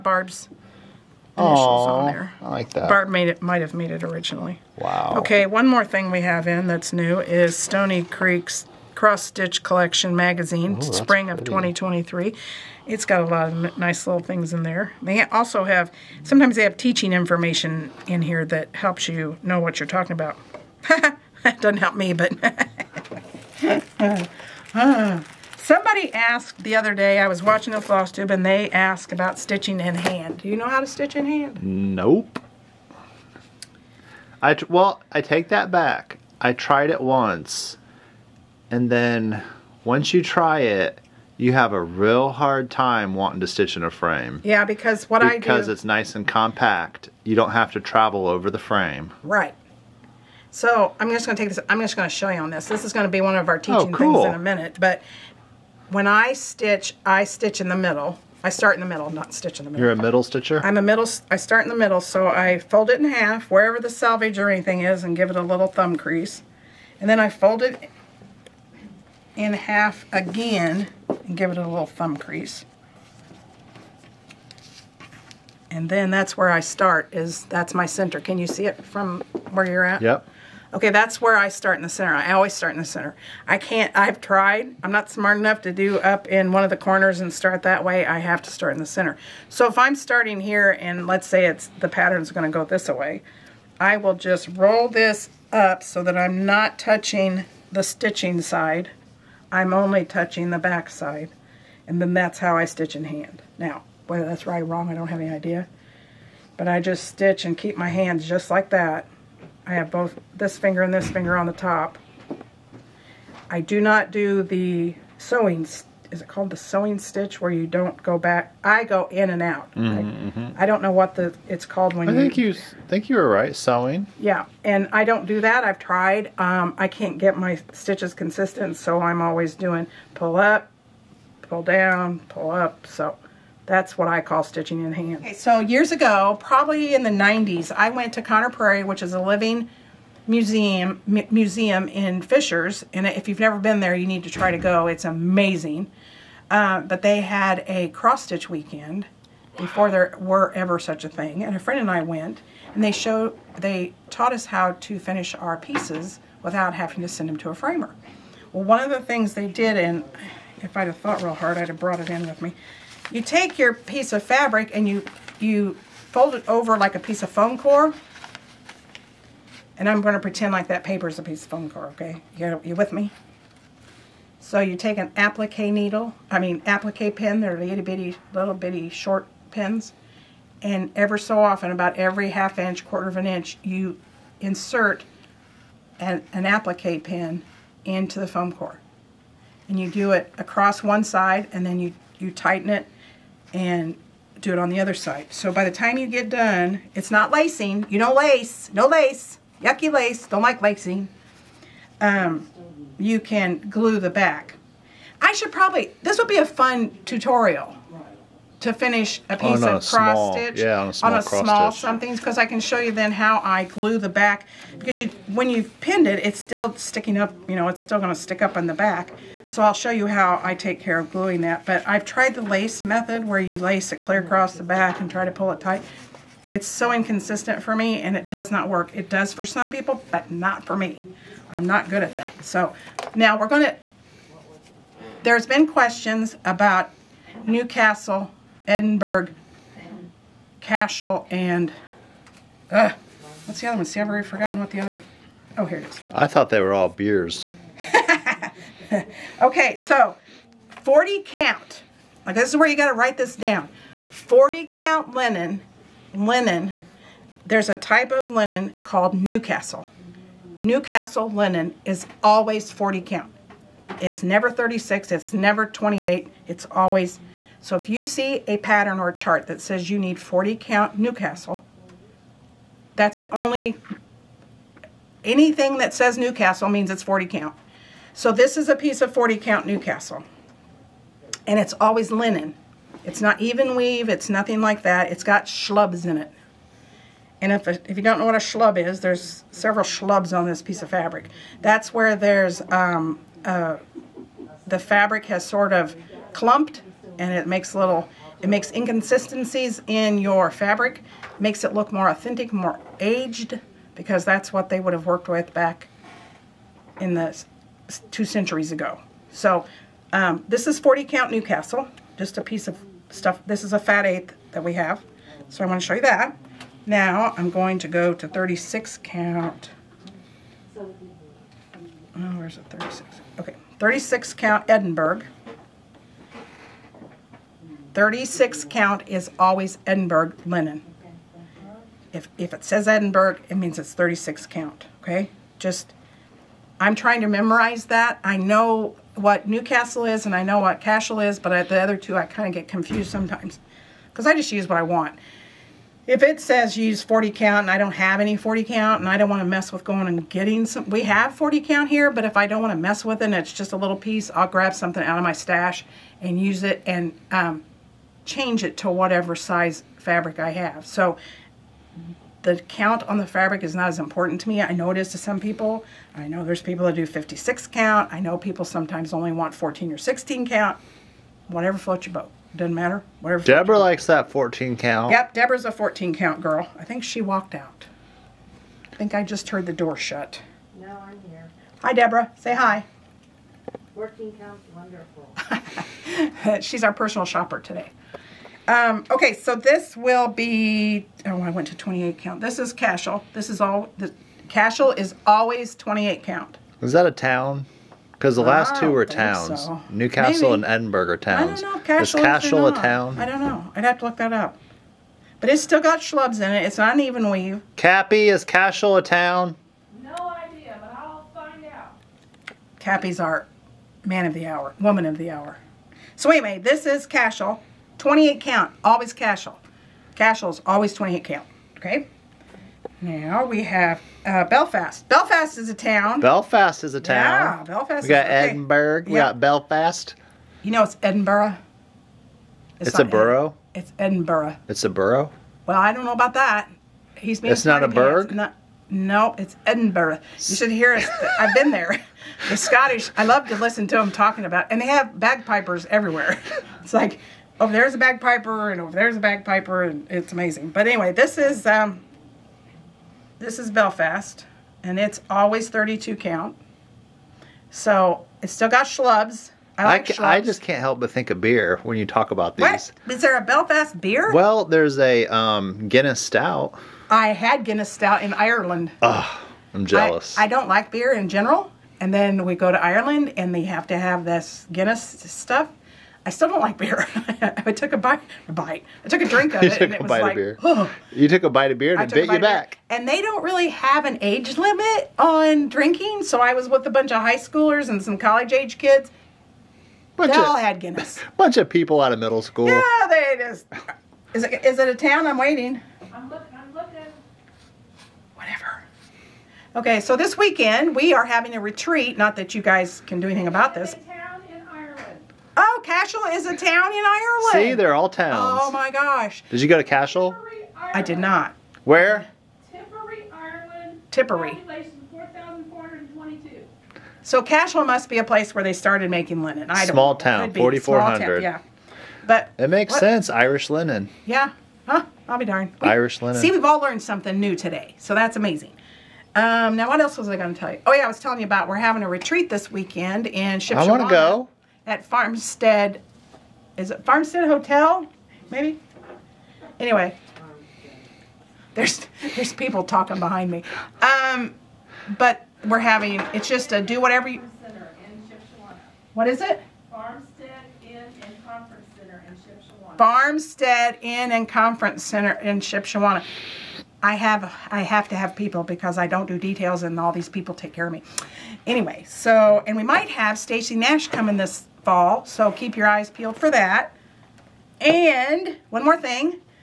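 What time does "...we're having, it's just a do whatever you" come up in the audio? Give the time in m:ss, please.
9:05.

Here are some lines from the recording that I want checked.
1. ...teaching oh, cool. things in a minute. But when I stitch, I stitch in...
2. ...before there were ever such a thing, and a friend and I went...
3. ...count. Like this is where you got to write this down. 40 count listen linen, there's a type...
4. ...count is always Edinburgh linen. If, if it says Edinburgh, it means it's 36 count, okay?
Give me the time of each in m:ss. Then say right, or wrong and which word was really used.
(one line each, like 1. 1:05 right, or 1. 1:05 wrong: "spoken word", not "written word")
1. 0:53 right
2. 2:29 right
3. 4:11 wrong: "linen", not "listen"
4. 5:28 right.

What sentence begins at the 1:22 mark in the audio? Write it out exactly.
I always start in the center.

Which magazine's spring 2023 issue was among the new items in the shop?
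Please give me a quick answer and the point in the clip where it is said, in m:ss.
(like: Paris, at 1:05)
Stony Creek's cross stitch collection, at 0:07.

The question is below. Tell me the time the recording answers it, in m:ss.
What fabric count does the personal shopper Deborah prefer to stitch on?
6:15.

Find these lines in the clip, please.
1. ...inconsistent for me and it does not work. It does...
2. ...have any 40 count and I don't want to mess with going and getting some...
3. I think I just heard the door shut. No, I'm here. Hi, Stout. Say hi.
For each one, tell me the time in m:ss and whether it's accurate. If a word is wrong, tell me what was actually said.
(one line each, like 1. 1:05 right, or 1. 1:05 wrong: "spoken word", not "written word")
1. 3:46 right
2. 5:47 right
3. 6:18 wrong: "Deborah", not "Stout".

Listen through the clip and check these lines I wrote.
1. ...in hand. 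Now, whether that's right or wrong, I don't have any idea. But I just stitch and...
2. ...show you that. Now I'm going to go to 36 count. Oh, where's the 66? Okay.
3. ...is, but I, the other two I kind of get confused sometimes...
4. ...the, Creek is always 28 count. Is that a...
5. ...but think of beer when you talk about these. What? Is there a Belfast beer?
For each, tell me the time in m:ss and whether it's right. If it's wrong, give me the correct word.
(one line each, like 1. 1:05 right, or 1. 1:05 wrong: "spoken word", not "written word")
1. 1:42 right
2. 5:15 wrong: "36", not "66"
3. 5:41 right
4. 6:33 wrong: "Cashel", not "Creek"
5. 7:41 right.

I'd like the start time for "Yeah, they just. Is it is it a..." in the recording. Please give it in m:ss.
8:12.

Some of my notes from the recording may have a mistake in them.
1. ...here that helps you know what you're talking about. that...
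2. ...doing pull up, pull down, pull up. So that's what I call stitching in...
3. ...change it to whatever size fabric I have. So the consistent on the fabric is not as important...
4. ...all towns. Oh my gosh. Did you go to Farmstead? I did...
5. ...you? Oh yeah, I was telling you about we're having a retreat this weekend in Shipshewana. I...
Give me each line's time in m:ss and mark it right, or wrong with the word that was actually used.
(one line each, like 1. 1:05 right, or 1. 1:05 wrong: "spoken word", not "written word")
1. 0:18 right
2. 2:09 right
3. 5:58 wrong: "count", not "consistent"
4. 8:27 wrong: "Cashel", not "Farmstead"
5. 8:50 right.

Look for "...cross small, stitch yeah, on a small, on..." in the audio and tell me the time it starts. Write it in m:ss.
3:29.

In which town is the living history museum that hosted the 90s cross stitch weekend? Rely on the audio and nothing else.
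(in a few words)
Fishers.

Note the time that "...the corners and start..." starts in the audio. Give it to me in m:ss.
1:26.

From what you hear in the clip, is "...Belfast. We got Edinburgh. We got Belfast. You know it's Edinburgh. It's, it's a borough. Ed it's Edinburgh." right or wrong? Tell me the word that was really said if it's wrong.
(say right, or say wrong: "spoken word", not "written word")
right.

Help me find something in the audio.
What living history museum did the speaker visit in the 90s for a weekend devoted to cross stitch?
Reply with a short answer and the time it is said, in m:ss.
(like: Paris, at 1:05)
Conner Prairie, at 2:18.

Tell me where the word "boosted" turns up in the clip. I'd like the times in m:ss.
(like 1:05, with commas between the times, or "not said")
not said.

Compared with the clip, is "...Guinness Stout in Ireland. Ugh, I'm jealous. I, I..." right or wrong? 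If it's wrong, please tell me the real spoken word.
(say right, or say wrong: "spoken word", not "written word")
right.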